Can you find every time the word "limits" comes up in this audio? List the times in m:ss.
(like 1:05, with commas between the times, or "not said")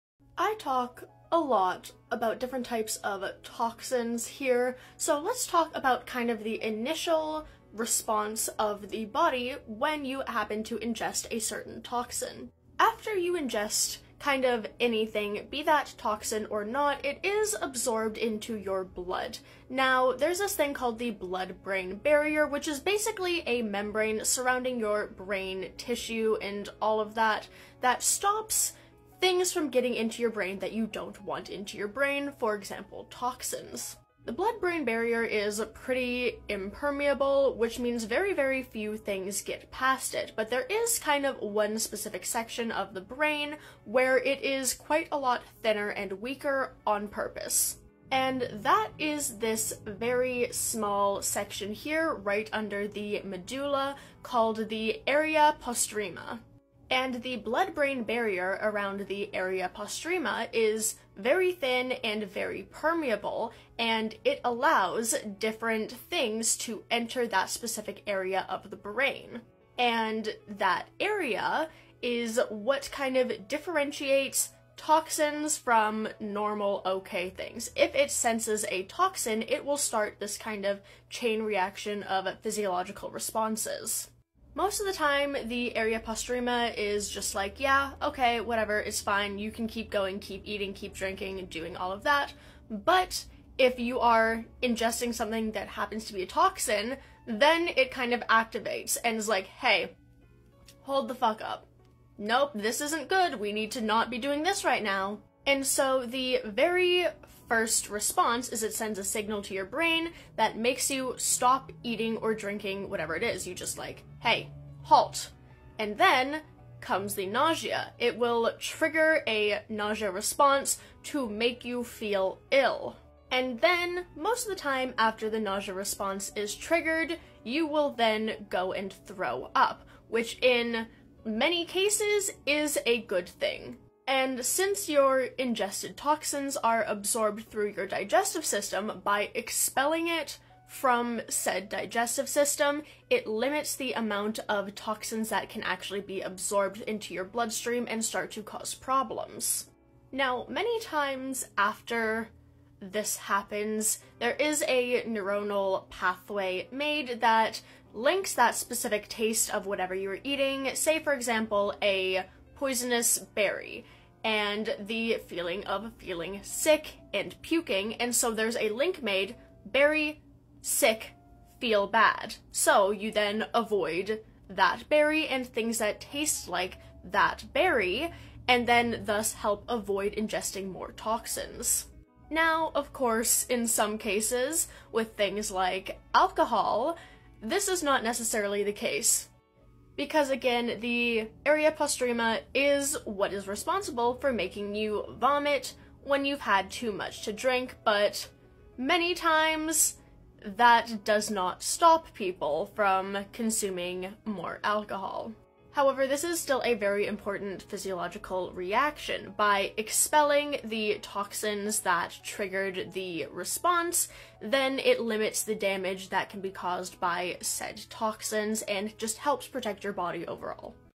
2:23, 3:34.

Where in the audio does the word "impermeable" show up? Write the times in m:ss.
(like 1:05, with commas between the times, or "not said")
0:36.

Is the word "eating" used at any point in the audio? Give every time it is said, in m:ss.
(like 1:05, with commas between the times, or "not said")
1:30, 1:51, 2:40.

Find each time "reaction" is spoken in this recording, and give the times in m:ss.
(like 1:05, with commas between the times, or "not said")
1:21, 3:28.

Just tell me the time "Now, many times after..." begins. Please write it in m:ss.
2:30.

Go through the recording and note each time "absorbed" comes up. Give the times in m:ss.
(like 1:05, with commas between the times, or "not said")
0:17, 2:16, 2:26.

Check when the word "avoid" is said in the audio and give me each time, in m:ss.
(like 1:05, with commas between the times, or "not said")
2:53, 2:59.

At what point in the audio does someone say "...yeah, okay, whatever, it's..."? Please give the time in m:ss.
1:27.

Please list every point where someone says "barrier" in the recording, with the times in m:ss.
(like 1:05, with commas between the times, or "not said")
0:21, 0:34, 0:58.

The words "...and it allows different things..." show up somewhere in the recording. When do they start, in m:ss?
1:03.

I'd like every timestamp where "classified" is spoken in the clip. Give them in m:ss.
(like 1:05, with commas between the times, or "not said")
not said.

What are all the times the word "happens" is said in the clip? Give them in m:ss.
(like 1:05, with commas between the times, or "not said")
0:10, 1:35, 2:33.